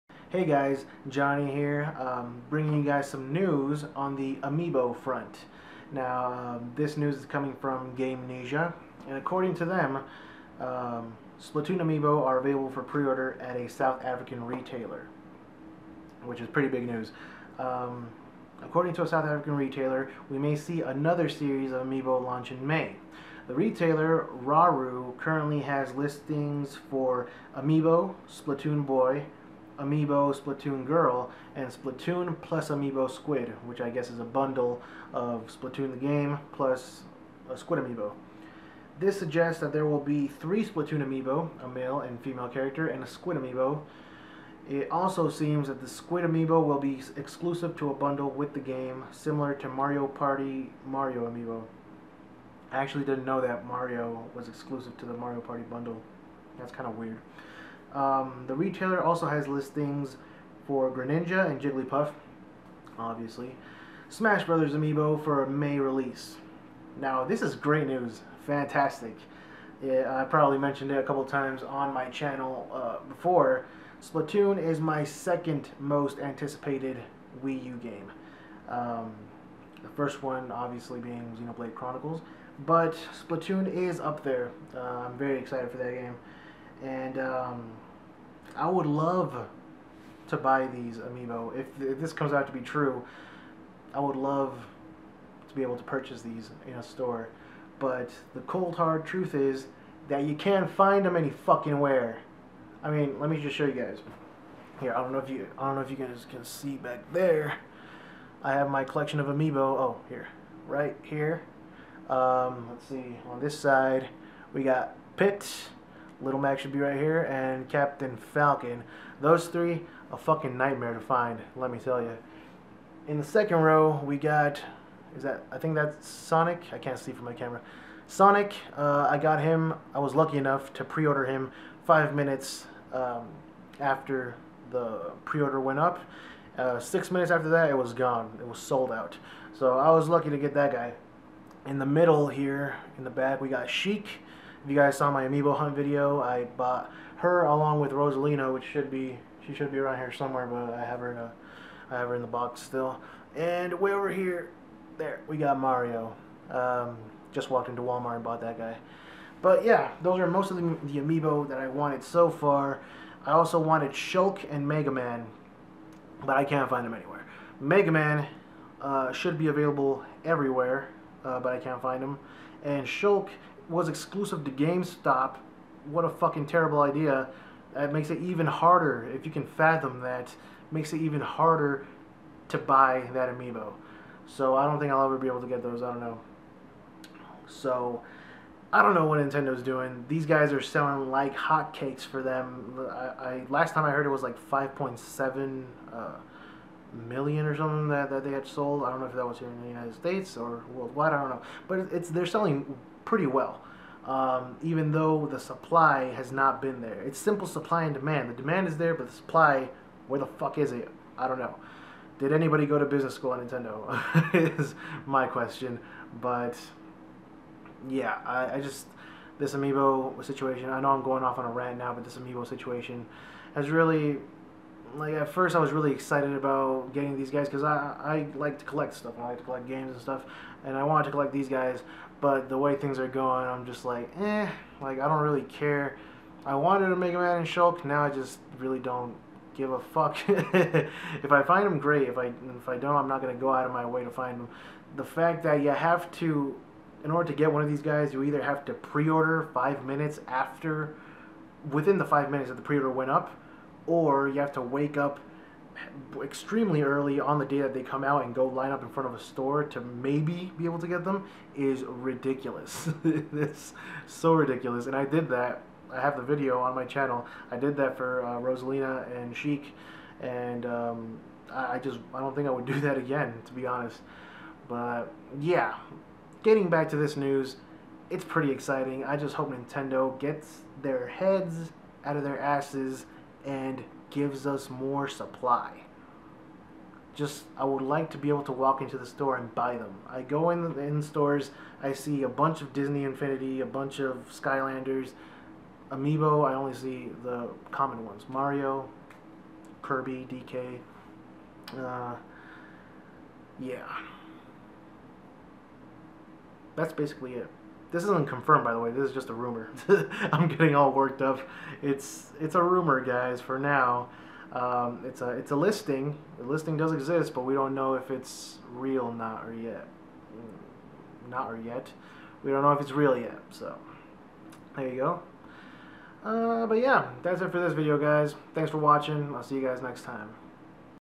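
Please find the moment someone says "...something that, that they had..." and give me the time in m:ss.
3:17.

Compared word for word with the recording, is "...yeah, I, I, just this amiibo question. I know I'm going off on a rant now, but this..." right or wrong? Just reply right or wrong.
wrong.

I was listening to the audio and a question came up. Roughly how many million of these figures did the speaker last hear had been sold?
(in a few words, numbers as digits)
5.7 million.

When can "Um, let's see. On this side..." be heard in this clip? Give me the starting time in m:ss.
1:52.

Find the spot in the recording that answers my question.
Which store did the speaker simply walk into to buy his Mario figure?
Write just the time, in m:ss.
2:37.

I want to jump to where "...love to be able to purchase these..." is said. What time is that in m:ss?
1:34.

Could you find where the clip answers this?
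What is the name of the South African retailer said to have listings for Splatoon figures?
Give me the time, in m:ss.
0:24.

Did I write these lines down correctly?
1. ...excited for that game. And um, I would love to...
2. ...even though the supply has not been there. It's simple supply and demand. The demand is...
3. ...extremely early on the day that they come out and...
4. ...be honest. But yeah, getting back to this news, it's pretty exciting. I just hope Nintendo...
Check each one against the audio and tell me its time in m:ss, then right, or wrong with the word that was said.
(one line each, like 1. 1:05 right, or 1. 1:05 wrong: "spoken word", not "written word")
1. 1:25 right
2. 3:24 right
3. 4:16 right
4. 4:33 right.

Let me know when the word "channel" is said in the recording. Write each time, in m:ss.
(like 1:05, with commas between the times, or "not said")
1:12, 4:26.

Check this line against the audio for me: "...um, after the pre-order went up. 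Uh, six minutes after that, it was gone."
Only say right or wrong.
right.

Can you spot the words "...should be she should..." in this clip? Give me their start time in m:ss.
2:28.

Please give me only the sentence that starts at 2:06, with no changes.
I can't see from my camera.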